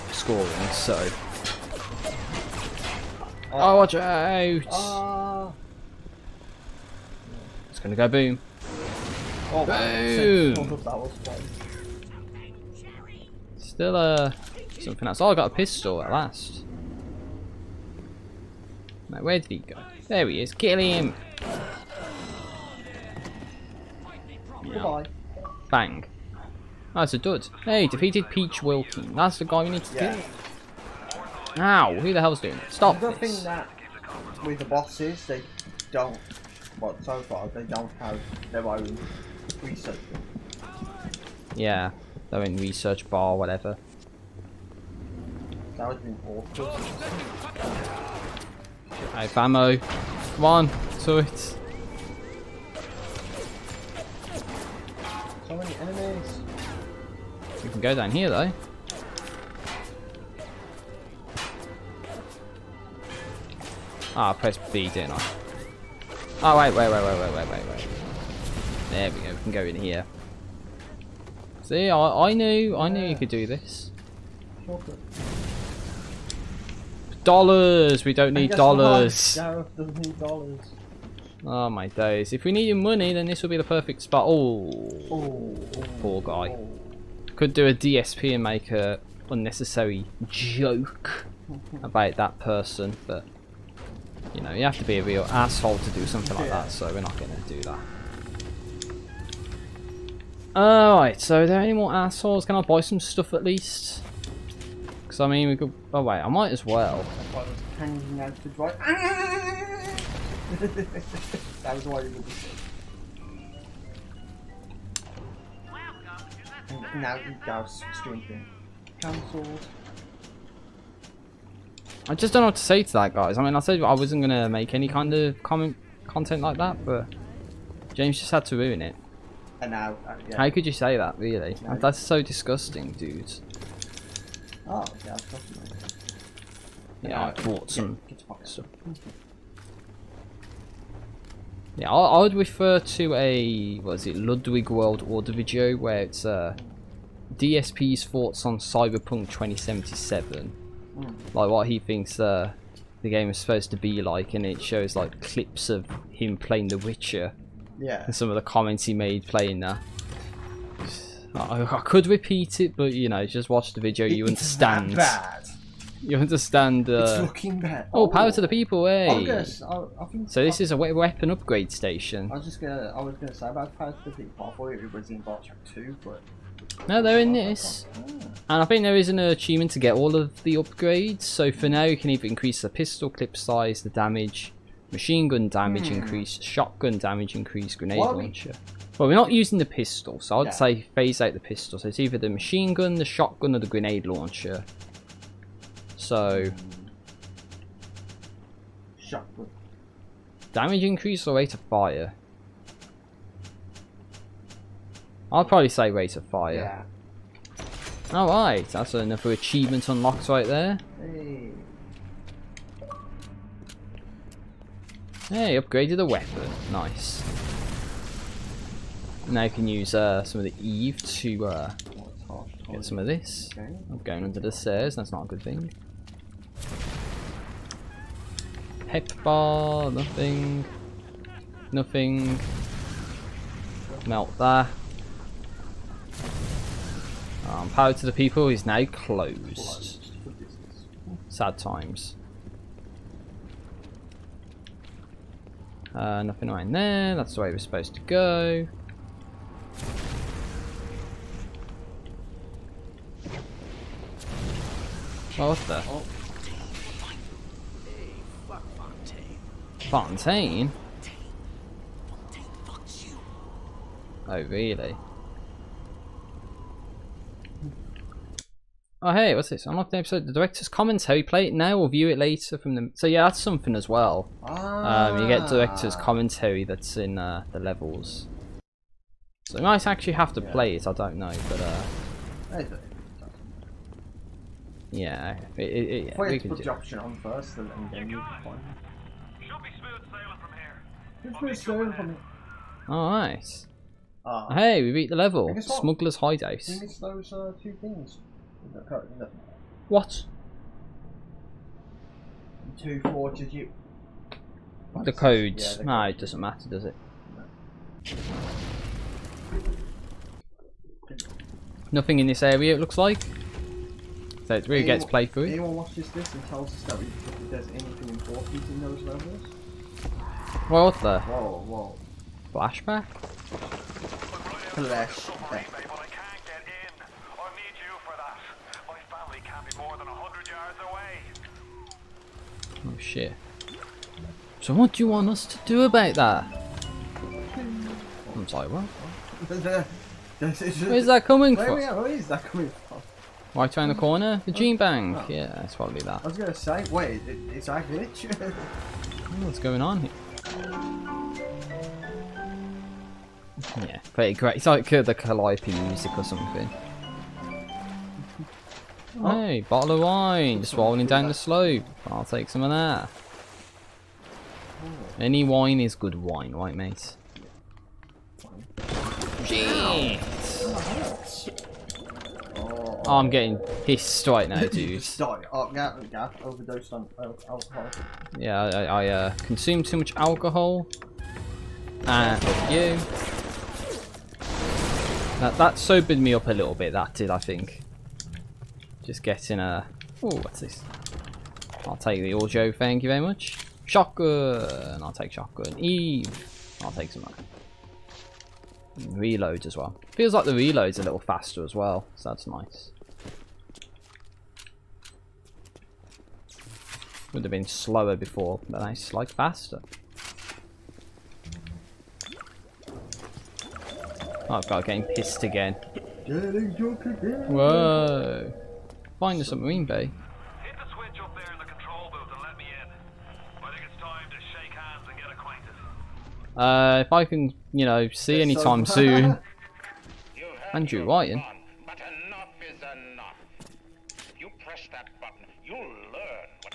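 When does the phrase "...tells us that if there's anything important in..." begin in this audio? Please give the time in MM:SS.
05:16.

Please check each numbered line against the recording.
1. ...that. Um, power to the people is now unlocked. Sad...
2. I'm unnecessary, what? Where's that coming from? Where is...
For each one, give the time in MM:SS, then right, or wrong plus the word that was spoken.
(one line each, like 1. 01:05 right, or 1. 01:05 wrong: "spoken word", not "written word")
1. 03:54 wrong: "closed", not "unlocked"
2. 05:38 wrong: "sorry", not "unnecessary".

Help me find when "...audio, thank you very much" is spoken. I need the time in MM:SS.
06:32.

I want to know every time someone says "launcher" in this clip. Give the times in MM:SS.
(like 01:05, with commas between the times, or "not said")
03:08, 03:14.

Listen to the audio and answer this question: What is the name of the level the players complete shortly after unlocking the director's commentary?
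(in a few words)
Smuggler's hideout.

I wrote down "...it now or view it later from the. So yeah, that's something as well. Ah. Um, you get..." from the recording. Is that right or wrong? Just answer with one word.
right.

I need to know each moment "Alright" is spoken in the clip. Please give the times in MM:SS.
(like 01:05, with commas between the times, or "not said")
01:40, 03:28.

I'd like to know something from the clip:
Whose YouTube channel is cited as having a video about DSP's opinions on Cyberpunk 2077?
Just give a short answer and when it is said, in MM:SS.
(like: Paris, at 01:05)
Ludwig World Order, at 02:24.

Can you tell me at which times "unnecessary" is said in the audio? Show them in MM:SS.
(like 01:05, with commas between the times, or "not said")
01:29.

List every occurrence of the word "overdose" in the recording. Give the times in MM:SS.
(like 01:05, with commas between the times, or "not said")
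06:16.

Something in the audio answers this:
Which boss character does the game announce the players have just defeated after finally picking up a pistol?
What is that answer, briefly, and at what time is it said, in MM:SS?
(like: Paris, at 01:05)
Peach Wilkins, at 00:28.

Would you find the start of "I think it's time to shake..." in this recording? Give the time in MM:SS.
07:03.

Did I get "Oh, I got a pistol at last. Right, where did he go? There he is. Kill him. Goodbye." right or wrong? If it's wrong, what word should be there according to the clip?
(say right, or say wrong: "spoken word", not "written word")
right.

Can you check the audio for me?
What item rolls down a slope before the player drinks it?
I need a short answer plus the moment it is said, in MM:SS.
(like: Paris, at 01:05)
Bottle of wine, at 05:59.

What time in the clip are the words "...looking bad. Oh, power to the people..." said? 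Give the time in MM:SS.
02:47.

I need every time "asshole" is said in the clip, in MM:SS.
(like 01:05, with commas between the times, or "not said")
01:35, 01:41.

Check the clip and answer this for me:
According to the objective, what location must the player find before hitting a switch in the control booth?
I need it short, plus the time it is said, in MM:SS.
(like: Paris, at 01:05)
The submarine bay, at 06:59.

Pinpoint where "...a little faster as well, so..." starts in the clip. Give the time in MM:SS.
06:40.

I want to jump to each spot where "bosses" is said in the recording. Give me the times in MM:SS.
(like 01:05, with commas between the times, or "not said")
00:34.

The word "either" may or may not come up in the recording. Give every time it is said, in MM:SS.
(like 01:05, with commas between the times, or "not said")
03:02, 03:11.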